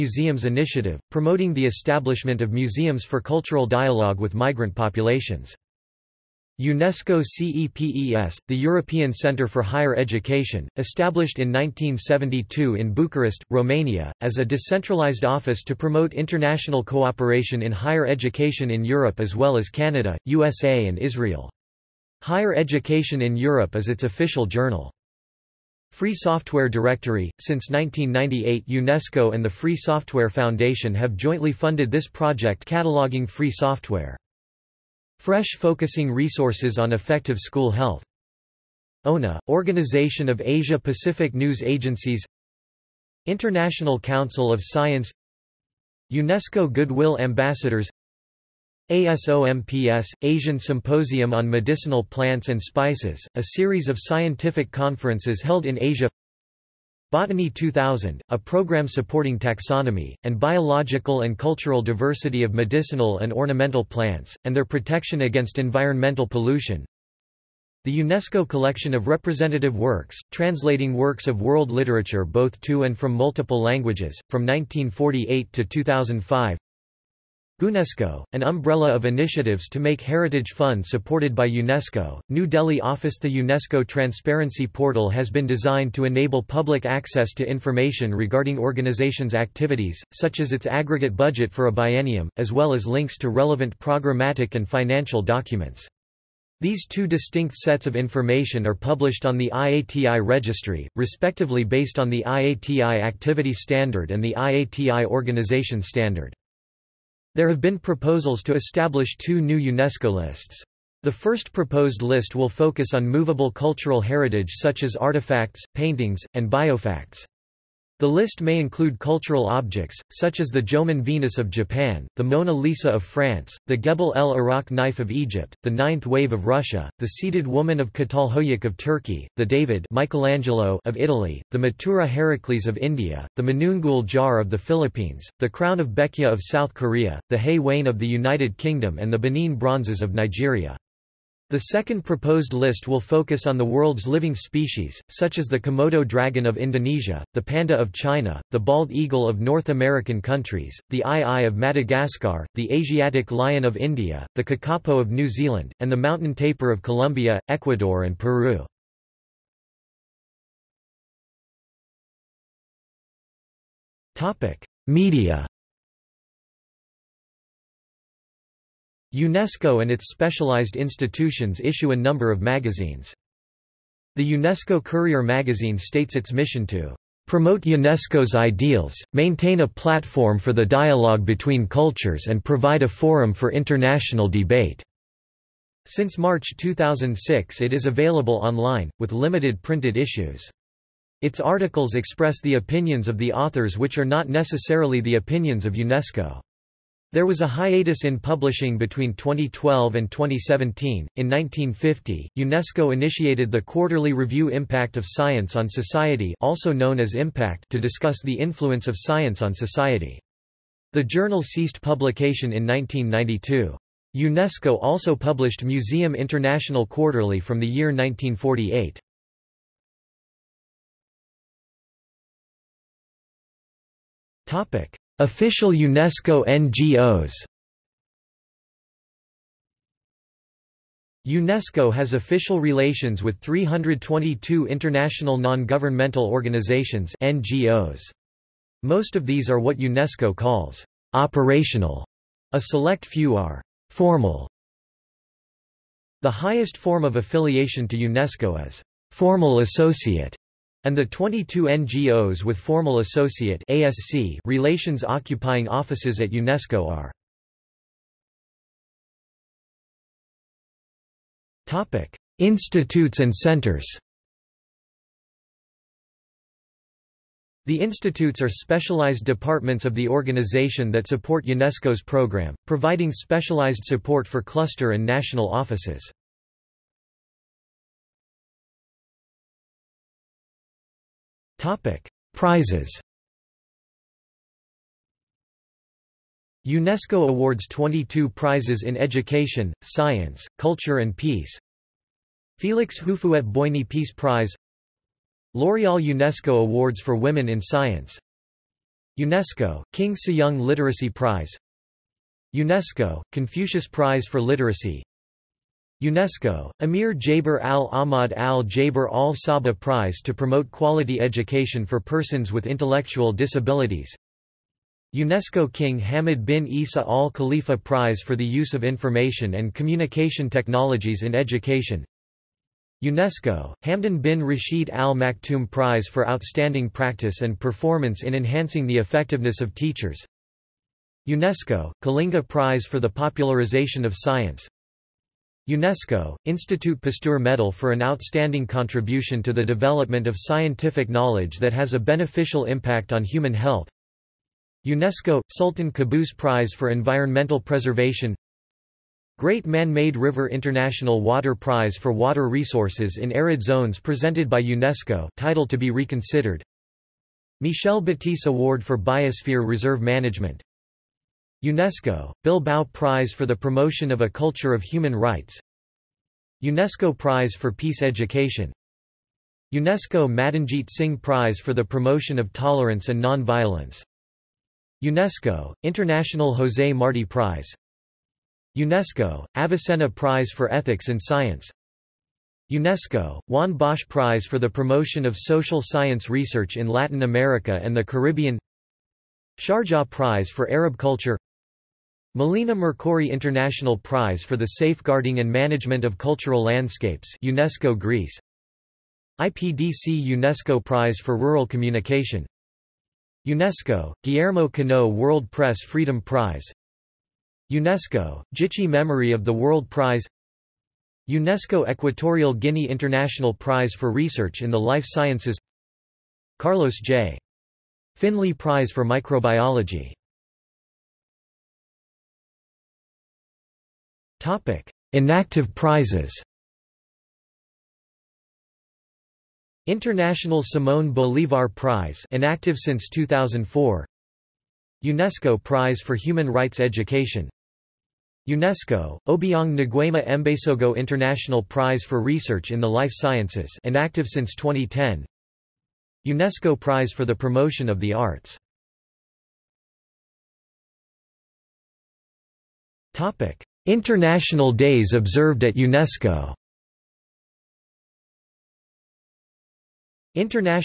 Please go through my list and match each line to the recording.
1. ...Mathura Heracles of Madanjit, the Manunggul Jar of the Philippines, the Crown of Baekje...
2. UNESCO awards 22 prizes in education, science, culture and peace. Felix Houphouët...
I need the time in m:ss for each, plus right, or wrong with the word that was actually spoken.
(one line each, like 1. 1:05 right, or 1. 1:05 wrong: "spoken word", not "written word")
1. 2:11 wrong: "India", not "Madanjit"
2. 4:46 right.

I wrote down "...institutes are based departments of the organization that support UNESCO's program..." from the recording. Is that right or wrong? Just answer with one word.
wrong.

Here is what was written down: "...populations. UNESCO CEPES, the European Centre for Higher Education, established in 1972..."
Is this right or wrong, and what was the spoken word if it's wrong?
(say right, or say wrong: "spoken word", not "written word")
right.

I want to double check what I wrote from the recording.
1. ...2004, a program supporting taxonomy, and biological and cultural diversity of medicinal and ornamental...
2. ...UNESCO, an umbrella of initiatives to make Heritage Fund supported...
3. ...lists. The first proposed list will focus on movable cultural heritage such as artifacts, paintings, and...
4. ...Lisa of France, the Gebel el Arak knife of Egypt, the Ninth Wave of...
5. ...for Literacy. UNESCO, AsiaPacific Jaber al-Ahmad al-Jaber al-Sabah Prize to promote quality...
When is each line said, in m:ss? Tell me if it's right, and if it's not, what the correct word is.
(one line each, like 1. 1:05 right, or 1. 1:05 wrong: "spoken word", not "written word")
1. 0:57 wrong: "2000", not "2004"
2. 1:17 right
3. 1:50 right
4. 2:02 right
5. 5:04 wrong: "Amir", not "AsiaPacific".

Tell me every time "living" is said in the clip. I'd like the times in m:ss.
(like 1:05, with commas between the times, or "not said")
2:24.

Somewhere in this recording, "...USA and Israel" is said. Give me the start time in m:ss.
0:20.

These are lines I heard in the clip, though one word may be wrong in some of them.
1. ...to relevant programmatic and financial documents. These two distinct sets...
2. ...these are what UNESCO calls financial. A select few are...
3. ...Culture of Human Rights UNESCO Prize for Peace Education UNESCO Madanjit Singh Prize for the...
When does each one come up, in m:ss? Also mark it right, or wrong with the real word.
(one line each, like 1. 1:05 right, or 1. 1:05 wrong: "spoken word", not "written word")
1. 1:33 right
2. 3:59 wrong: "operational", not "financial"
3. 6:04 right.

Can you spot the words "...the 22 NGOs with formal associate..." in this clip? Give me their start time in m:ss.
4:10.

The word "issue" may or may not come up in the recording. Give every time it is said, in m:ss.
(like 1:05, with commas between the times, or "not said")
2:51, 3:09.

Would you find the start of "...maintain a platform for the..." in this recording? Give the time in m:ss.
2:59.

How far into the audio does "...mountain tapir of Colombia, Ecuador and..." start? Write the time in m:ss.
2:35.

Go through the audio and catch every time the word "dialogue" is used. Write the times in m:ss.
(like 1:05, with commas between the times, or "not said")
0:03, 3:00.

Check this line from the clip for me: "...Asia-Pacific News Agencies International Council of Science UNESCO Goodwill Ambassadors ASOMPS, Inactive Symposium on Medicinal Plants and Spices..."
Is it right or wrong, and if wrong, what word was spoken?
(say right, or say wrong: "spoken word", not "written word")
wrong: "Asian", not "Inactive".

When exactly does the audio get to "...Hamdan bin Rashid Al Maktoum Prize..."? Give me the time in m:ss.
5:23.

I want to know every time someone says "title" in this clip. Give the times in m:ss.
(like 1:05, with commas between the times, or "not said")
5:55.